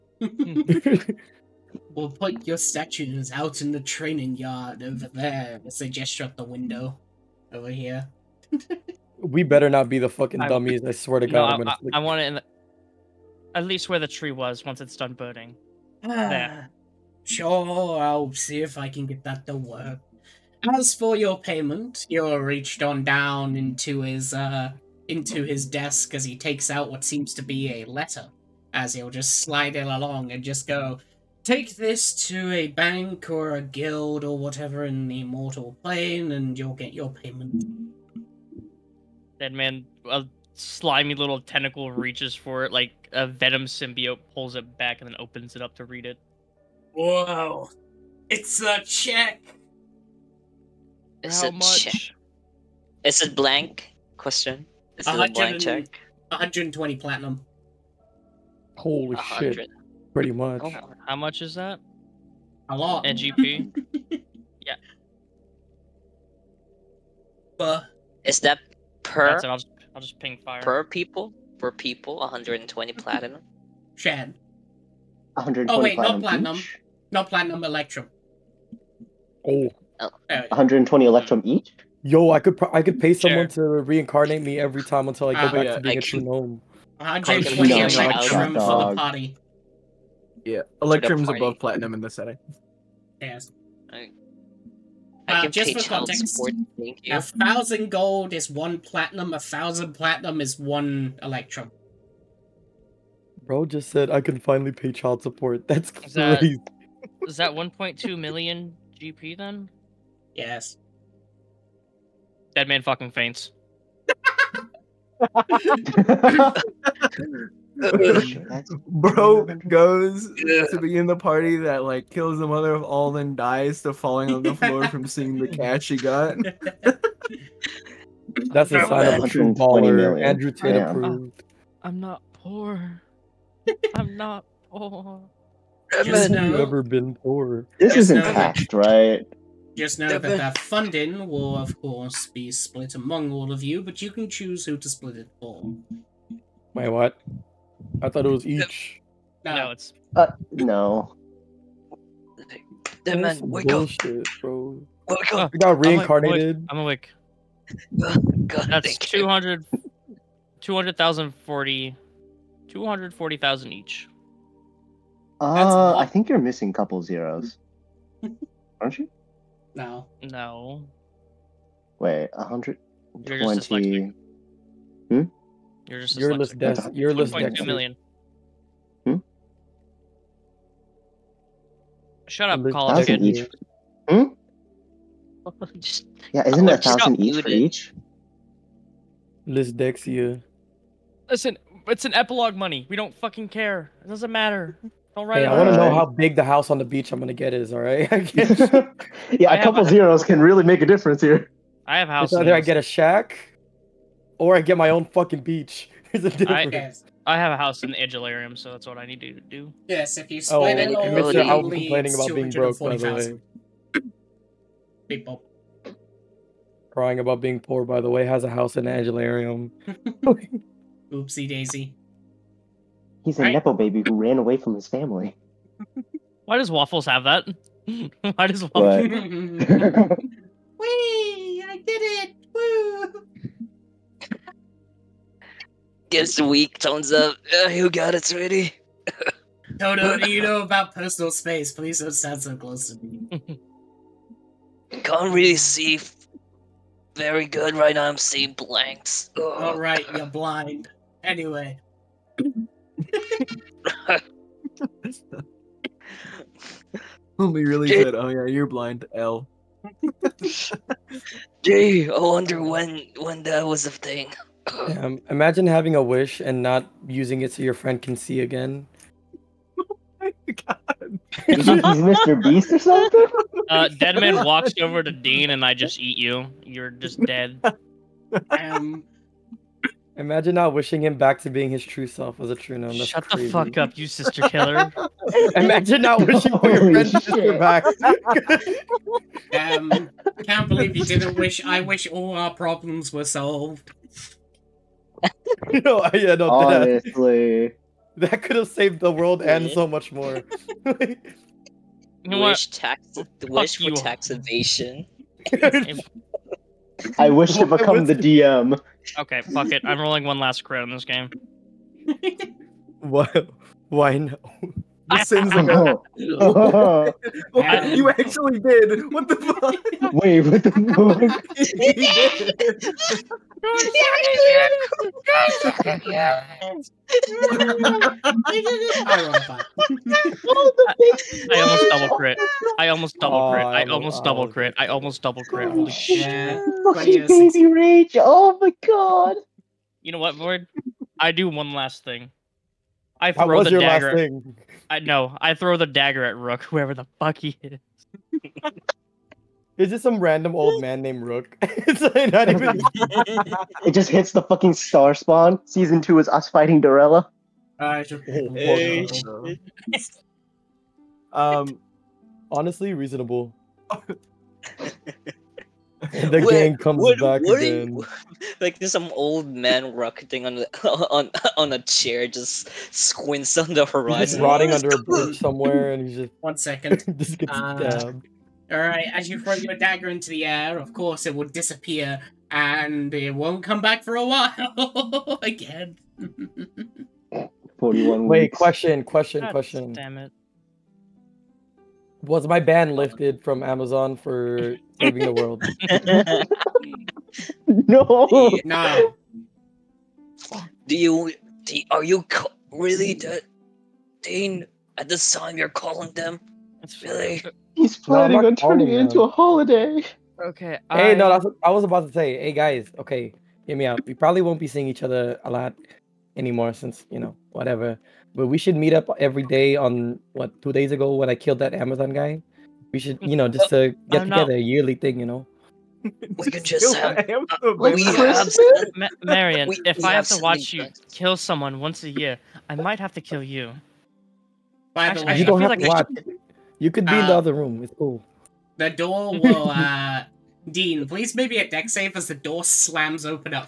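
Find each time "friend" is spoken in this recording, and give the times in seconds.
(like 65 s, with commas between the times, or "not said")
267 s, 286 s.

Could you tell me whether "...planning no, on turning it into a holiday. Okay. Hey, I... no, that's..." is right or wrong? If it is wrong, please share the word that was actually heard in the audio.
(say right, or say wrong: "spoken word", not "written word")
right.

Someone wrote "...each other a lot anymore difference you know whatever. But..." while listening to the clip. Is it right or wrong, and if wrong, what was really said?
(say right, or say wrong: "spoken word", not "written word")
wrong: "since", not "difference".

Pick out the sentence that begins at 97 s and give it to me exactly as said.
A thousand gold is one platinum.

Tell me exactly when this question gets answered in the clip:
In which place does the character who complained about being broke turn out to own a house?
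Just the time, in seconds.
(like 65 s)
207 s.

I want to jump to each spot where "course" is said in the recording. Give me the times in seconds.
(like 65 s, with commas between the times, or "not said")
141 s, 380 s.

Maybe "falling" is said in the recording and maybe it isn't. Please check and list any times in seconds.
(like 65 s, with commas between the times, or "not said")
123 s.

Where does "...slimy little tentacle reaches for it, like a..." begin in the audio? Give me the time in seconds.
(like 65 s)
40 s.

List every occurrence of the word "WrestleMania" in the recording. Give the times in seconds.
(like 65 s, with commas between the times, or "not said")
not said.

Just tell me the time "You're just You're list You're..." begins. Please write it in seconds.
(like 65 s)
175 s.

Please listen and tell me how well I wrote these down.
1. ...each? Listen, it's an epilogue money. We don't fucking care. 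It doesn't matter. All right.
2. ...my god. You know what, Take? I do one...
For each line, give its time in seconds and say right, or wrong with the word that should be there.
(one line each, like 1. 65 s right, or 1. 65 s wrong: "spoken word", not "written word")
1. 187 s right
2. 338 s wrong: "Void", not "Take".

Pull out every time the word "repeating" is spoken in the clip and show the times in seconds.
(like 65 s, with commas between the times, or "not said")
not said.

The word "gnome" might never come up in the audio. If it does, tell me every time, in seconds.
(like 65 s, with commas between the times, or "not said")
86 s, 282 s.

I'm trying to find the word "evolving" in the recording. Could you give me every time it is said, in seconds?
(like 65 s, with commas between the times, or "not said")
not said.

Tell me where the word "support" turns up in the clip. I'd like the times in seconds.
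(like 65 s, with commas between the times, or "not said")
96 s, 105 s.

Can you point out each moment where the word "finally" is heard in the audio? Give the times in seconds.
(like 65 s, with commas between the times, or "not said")
104 s.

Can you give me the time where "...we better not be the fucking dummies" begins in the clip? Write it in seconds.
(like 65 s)
9 s.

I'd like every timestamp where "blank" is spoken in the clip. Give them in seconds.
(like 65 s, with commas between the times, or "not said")
53 s, 248 s.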